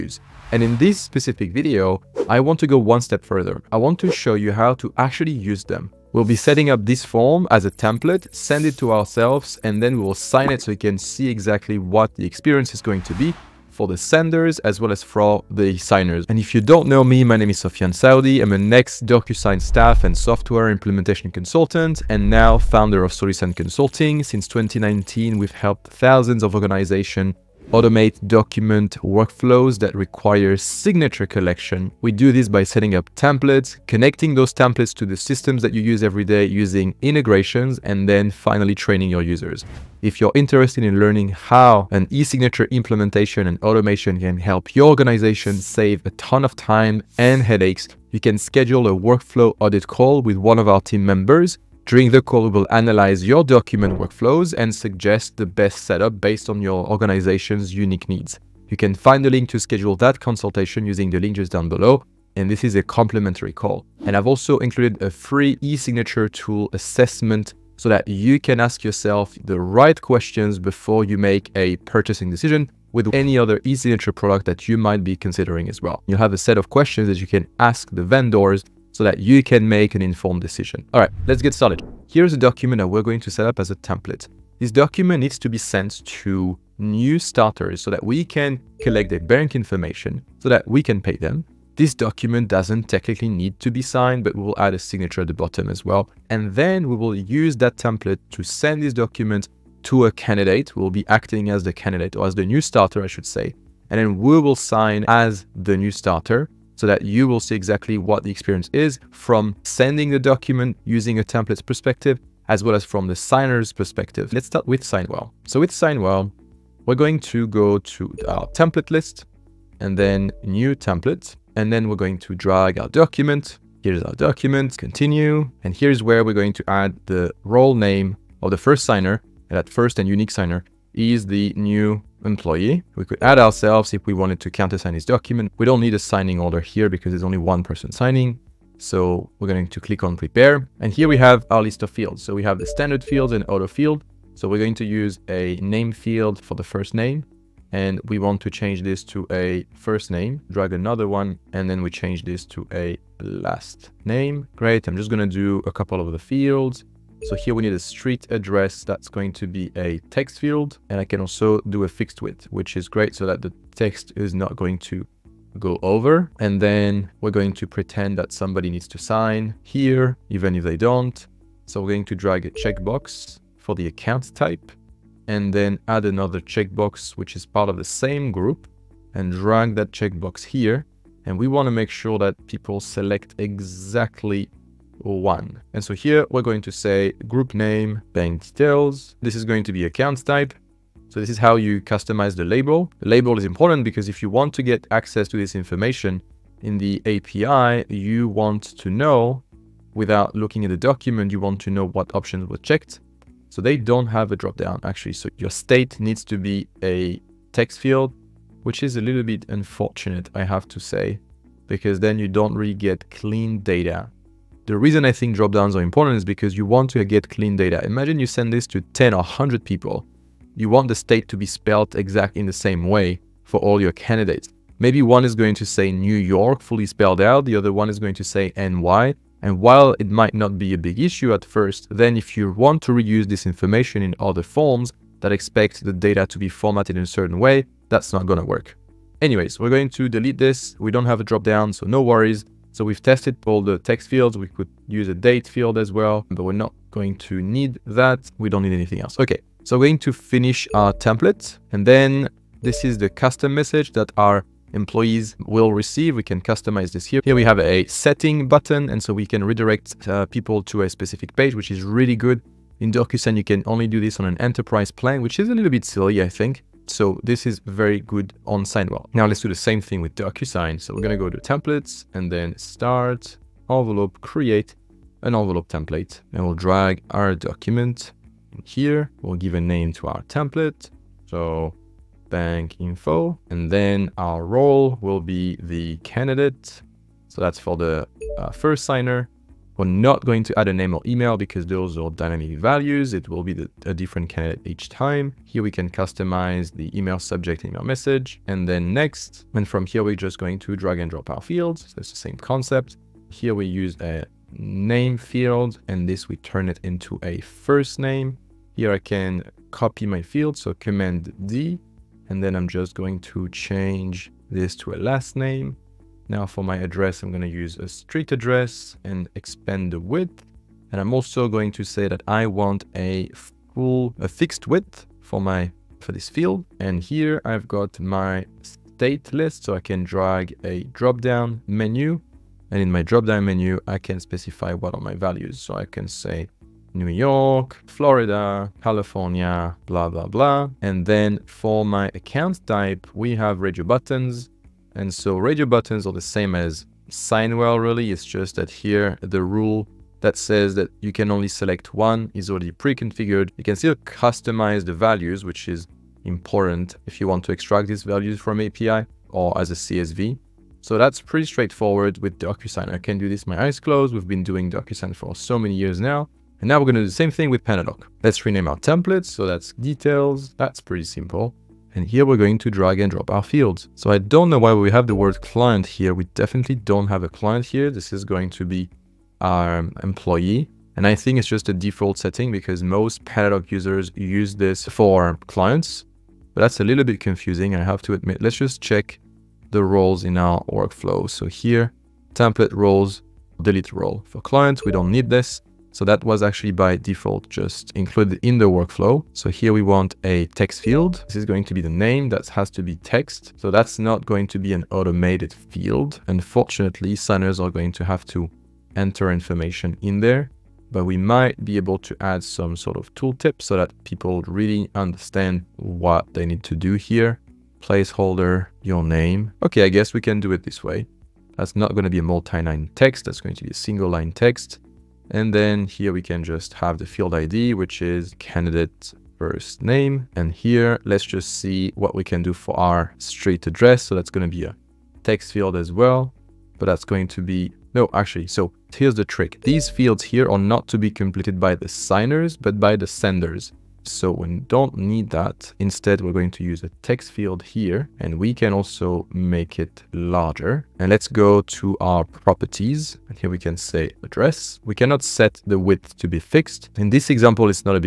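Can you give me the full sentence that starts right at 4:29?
Now let's do the same thing with DocuSign.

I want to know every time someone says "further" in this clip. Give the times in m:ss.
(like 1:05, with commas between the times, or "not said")
0:03.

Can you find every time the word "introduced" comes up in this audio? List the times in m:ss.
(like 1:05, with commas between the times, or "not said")
not said.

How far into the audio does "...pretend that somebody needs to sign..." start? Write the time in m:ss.
2:47.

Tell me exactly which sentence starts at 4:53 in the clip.
It will be the, a different candidate each time.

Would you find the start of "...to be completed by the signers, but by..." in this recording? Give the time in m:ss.
7:20.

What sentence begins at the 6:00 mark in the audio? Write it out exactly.
So that's pretty straightforward with DocuSign.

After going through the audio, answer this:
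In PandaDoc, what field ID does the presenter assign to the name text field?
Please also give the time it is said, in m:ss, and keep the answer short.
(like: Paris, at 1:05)
candidate first name, at 7:08.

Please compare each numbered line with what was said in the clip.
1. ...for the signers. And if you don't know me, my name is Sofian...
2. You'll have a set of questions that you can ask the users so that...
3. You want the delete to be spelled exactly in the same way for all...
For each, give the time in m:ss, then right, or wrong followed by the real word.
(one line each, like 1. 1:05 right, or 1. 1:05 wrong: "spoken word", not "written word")
1. 0:15 right
2. 1:16 wrong: "vendors", not "users"
3. 3:40 wrong: "state", not "delete".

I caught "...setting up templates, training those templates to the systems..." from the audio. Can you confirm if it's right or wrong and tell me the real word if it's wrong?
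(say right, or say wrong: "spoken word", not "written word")
wrong: "connecting", not "training".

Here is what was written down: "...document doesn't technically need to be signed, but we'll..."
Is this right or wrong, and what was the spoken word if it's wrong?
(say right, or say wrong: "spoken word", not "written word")
right.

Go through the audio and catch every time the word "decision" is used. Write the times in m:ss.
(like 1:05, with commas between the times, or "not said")
1:12, 1:20.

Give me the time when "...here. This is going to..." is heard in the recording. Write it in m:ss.
6:17.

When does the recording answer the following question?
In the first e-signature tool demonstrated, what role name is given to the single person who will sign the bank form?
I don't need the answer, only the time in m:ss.
2:11.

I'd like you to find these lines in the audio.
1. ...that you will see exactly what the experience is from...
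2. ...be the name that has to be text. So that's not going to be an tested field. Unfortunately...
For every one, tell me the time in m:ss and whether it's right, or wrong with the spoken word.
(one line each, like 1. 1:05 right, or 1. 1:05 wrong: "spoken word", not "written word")
1. 1:46 right
2. 6:41 wrong: "automated", not "tested".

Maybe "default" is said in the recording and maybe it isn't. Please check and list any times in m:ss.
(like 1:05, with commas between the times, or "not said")
6:21, 6:36.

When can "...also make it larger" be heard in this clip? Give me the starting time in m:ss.
7:28.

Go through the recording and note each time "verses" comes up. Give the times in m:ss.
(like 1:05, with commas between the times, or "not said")
not said.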